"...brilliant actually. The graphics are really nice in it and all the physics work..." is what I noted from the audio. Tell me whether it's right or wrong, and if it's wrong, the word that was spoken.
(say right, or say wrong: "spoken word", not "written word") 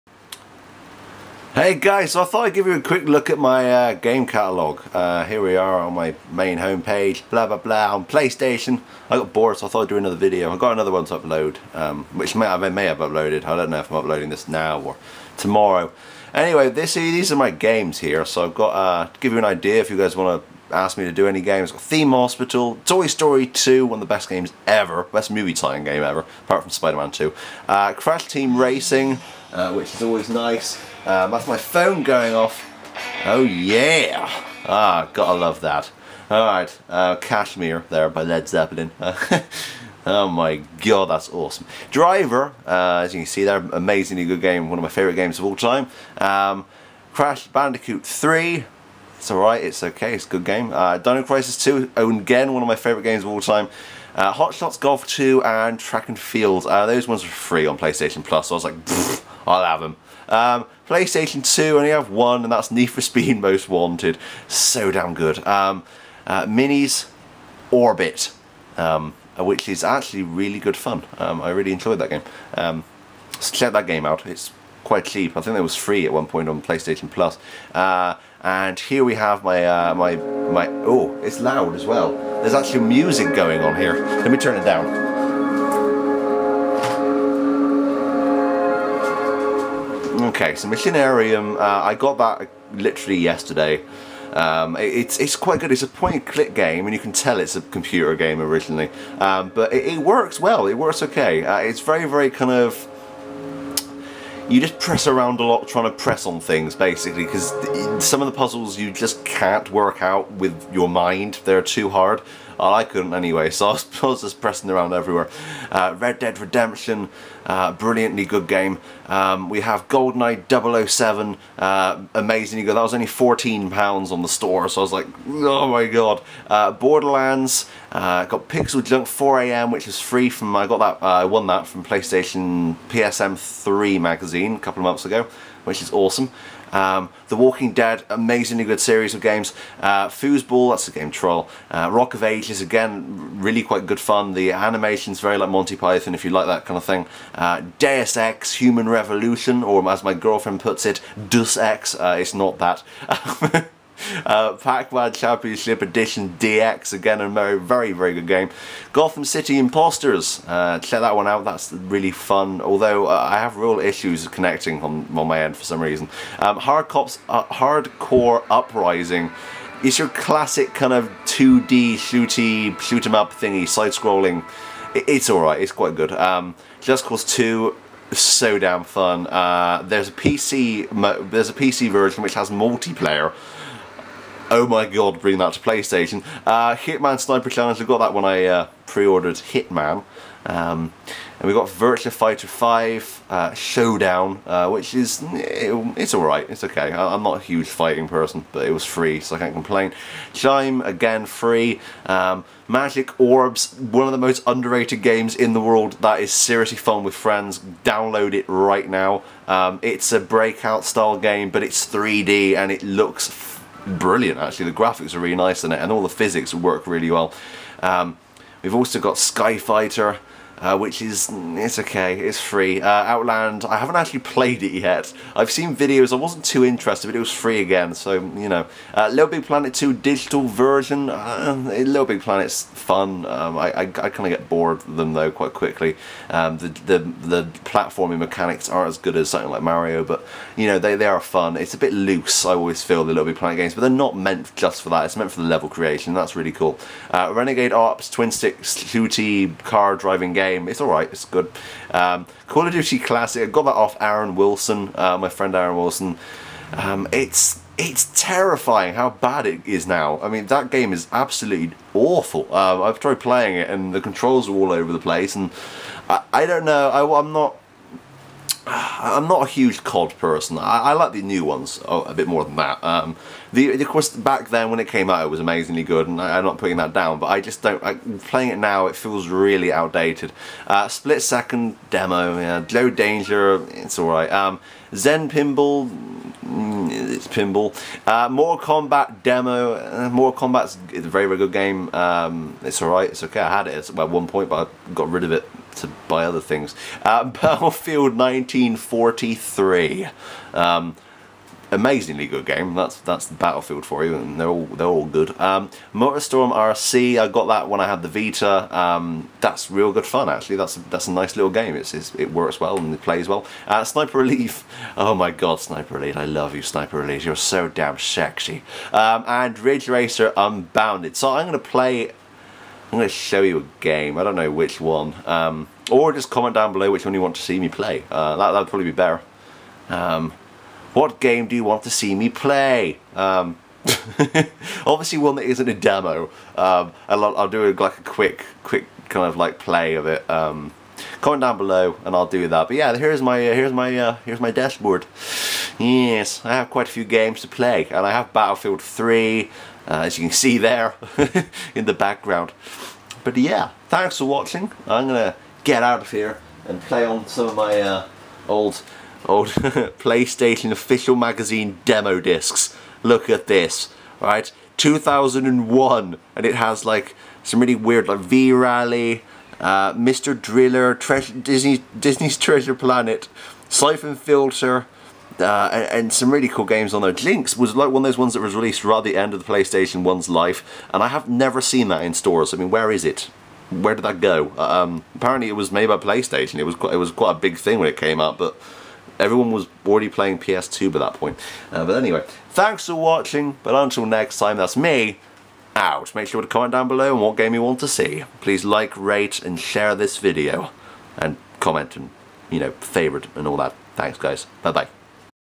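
right.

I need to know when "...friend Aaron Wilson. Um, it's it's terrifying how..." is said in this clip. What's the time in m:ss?
4:15.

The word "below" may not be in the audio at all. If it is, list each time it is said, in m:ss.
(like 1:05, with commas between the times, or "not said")
5:26, 5:41, 6:36.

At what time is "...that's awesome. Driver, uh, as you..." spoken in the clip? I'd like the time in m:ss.
0:41.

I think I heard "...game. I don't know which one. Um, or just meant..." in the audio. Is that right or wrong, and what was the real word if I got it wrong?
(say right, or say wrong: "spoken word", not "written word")
wrong: "comment", not "meant".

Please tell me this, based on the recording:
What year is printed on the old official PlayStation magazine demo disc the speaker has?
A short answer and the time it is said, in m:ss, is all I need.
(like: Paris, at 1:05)
2001, at 6:04.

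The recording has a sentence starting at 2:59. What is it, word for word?
Uh, there's a PC there's a PC version which has multiplayer, oh my god, bring that to PlayStation.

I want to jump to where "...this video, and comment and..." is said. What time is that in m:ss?
6:39.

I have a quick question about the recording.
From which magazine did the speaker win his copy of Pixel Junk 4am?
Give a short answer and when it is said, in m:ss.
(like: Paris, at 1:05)
PSM3, at 2:12.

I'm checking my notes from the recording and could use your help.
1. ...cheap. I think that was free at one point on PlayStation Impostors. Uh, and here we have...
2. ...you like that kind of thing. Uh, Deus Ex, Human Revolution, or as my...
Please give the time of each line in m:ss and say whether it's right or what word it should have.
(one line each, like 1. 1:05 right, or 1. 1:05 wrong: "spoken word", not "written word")
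1. 1:15 wrong: "Plus", not "Impostors"
2. 2:26 right.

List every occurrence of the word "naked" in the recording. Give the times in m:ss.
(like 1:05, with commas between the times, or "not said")
not said.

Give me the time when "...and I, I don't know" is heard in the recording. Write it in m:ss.
4:25.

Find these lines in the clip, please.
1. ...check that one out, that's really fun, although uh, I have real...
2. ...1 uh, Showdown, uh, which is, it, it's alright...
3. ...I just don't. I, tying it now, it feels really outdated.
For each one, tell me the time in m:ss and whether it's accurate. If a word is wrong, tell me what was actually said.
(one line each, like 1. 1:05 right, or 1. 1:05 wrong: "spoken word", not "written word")
1. 2:40 right
2. 3:12 wrong: "5", not "1"
3. 4:37 wrong: "playing", not "tying".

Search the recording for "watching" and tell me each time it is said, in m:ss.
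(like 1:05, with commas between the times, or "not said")
5:54, 6:32.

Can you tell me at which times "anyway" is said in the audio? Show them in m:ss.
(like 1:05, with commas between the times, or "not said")
0:16, 1:53, 6:31.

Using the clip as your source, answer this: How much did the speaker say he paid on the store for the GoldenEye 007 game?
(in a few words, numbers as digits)
£14.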